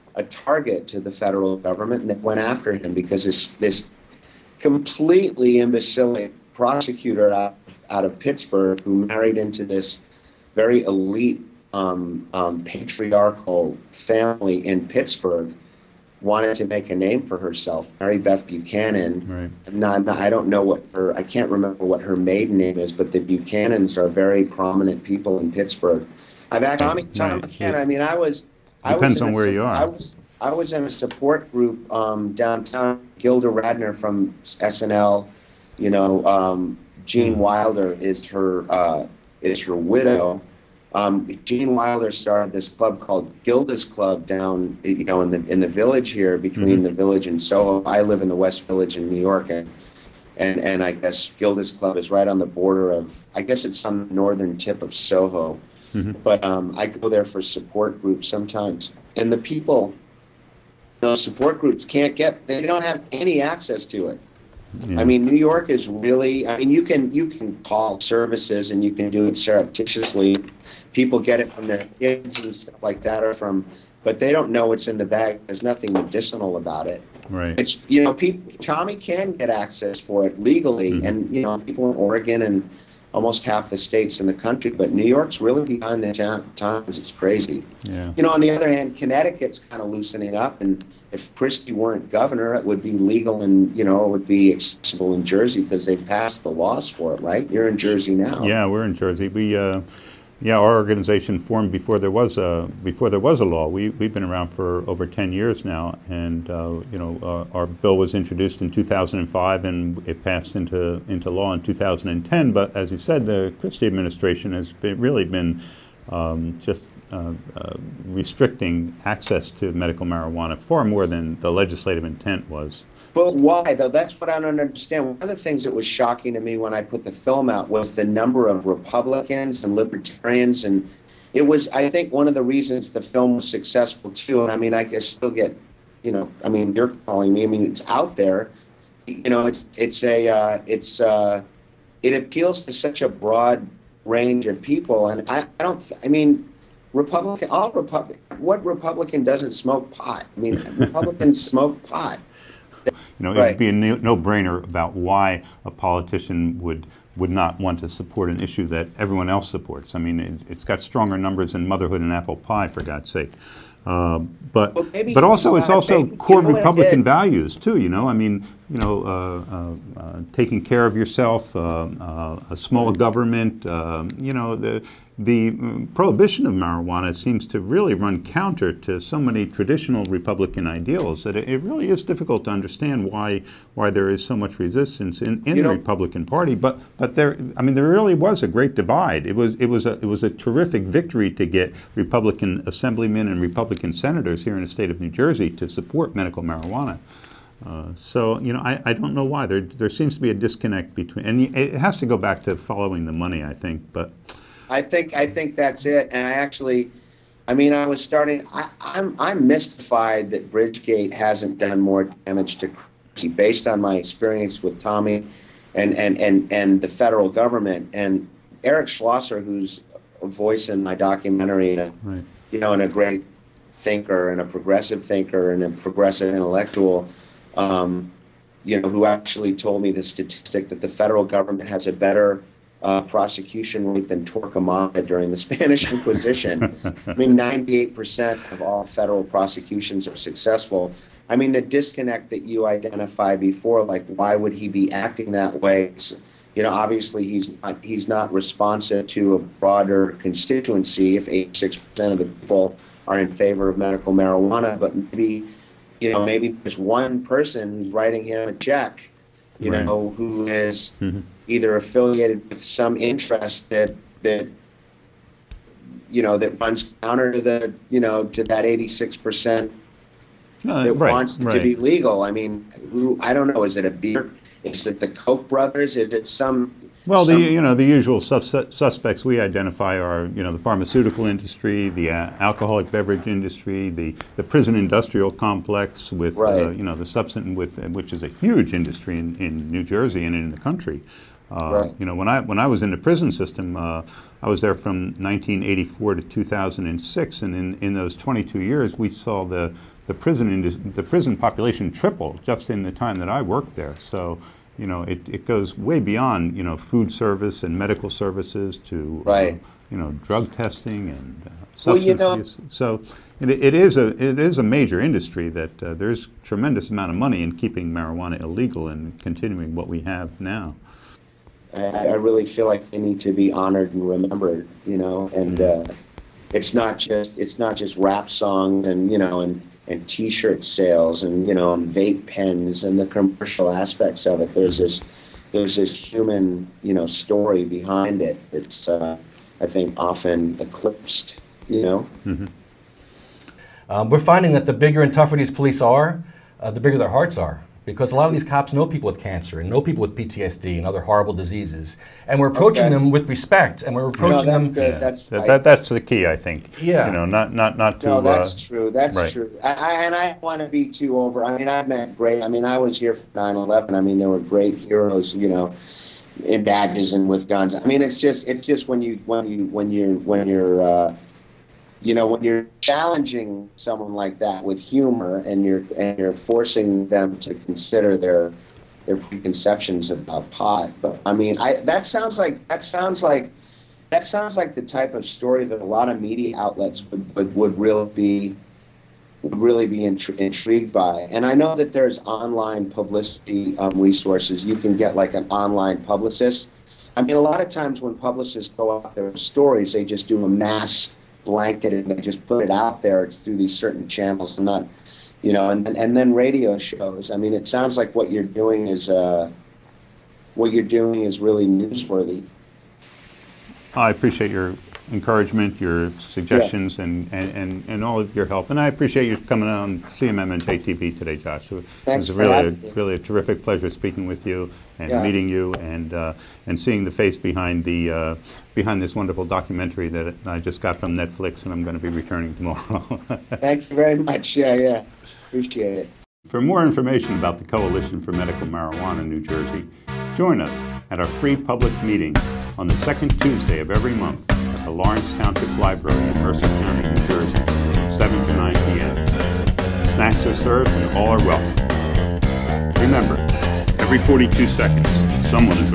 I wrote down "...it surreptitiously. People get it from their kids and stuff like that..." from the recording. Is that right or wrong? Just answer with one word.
right.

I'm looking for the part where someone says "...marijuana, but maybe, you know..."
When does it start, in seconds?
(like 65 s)
254 s.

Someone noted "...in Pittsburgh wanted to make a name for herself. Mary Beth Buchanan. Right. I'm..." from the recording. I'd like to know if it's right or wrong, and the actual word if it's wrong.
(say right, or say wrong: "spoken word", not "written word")
right.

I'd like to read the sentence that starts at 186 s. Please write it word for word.
But but there, I mean, there really was a great divide.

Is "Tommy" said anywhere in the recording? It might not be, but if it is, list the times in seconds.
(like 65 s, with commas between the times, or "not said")
27 s, 78 s, 214 s.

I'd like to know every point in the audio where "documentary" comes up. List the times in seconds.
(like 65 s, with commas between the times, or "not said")
220 s, 429 s.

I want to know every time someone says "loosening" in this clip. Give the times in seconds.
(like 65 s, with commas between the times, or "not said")
89 s.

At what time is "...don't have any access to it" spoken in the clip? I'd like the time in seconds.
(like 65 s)
62 s.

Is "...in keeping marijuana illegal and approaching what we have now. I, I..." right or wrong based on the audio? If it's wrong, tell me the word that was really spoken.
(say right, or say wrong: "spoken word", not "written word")
wrong: "continuing", not "approaching".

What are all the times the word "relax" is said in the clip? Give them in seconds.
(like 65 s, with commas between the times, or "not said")
not said.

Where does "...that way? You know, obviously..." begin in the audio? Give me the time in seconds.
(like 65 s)
245 s.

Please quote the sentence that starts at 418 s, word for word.
And I appreciate you coming on CMMNJ TV today, Josh.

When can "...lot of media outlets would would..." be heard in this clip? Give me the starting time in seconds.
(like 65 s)
385 s.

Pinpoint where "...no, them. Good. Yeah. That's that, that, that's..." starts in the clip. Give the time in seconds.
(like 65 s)
354 s.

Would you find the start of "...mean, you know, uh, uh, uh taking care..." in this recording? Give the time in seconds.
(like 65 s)
168 s.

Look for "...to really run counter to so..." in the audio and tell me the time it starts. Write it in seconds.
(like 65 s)
177 s.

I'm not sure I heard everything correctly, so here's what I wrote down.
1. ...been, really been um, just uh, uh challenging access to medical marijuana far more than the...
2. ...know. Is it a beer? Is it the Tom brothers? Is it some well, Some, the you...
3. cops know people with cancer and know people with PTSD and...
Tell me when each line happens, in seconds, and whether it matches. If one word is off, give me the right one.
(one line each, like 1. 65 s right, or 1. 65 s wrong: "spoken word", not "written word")
1. 114 s wrong: "restricting", not "challenging"
2. 273 s wrong: "Koch", not "Tom"
3. 348 s right.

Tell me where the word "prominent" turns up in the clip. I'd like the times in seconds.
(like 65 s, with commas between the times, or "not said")
24 s.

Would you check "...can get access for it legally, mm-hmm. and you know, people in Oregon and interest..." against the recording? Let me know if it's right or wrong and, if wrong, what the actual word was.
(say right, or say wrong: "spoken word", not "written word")
wrong: "almost", not "interest".